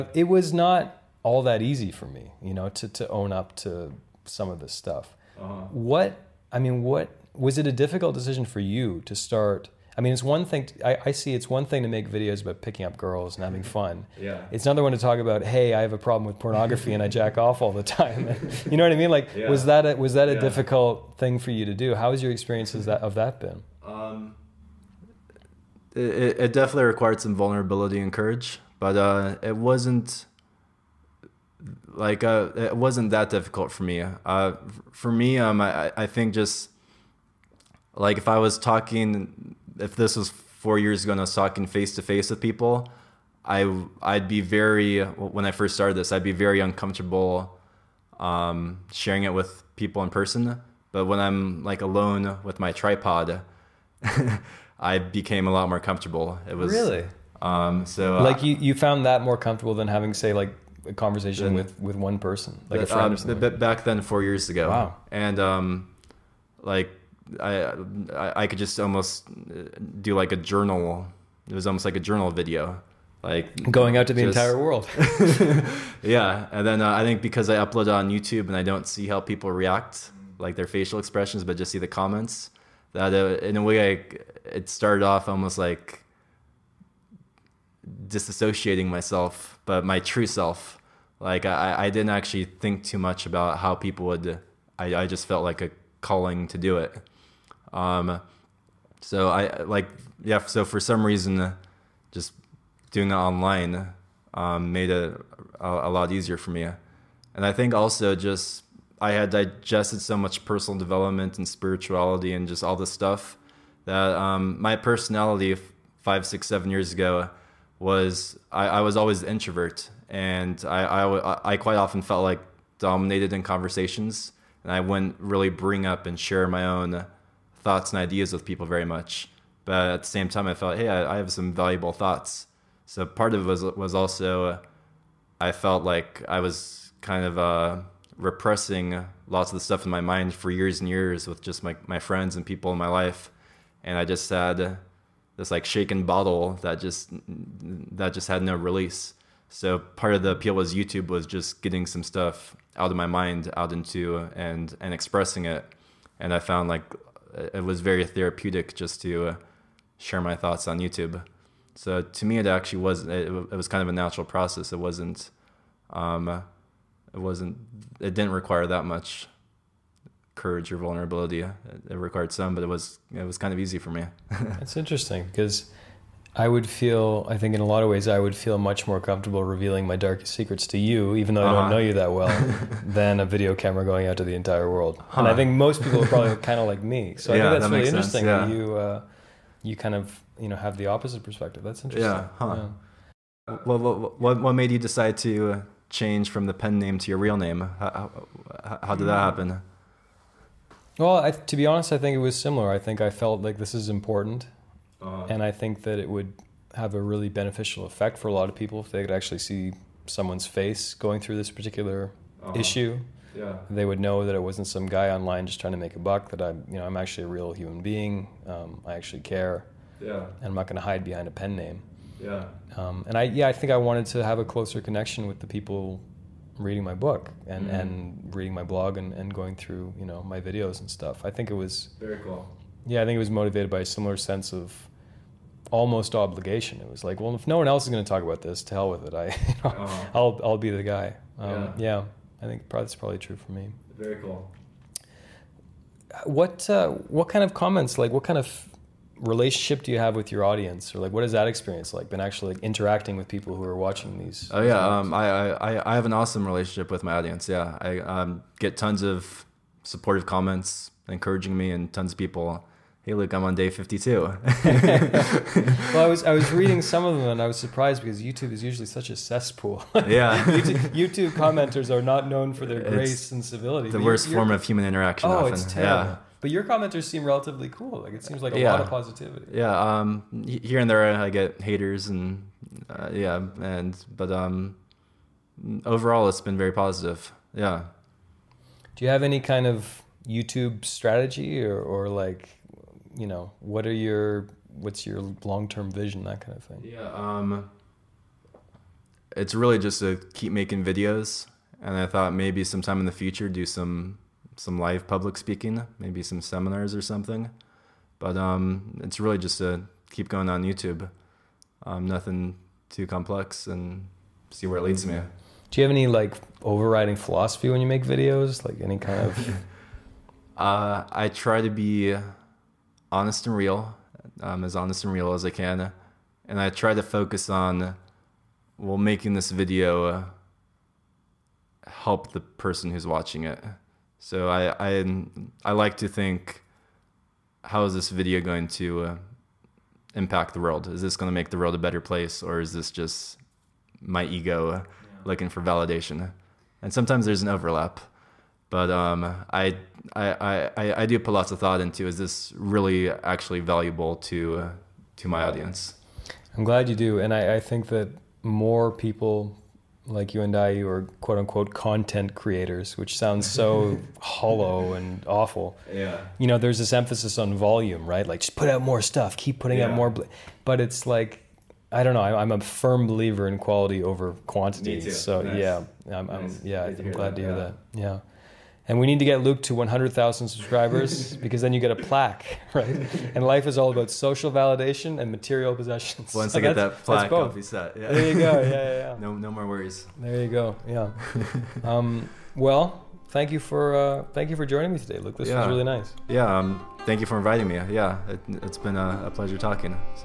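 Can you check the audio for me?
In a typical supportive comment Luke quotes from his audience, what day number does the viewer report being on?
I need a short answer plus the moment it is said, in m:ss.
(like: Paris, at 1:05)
52, at 4:23.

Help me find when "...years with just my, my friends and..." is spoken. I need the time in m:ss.
2:20.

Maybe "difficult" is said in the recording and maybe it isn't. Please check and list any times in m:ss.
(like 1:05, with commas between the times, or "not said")
0:07, 0:20, 0:33.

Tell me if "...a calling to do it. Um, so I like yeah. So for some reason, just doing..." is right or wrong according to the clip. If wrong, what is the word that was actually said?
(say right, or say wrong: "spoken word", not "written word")
right.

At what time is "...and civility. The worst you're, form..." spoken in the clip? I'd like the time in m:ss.
4:33.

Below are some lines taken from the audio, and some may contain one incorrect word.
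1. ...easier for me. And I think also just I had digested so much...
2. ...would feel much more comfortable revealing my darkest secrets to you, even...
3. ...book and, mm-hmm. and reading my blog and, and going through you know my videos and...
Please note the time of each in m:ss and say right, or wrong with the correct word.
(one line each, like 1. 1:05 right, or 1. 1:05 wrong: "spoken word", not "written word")
1. 1:46 right
2. 2:58 right
3. 3:46 right.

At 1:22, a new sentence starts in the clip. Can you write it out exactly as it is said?
That uh, in a way, I, it started off almost like disassociating myself, but my true self.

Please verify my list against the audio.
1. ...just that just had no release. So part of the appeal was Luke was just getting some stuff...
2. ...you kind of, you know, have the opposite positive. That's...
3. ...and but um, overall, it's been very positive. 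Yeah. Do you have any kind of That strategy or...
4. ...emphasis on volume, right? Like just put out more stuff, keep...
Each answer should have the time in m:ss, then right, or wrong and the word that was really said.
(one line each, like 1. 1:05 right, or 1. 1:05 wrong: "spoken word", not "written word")
1. 2:26 wrong: "YouTube", not "Luke"
2. 3:09 wrong: "perspective", not "positive"
3. 4:43 wrong: "YouTube", not "That"
4. 6:06 right.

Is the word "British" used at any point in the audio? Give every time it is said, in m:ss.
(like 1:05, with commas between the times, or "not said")
not said.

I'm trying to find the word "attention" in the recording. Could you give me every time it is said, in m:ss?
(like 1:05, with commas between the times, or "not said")
not said.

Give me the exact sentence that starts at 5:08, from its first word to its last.
But um, it's really just to keep going on YouTube.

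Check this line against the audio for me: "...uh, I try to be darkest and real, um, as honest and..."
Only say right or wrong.
wrong.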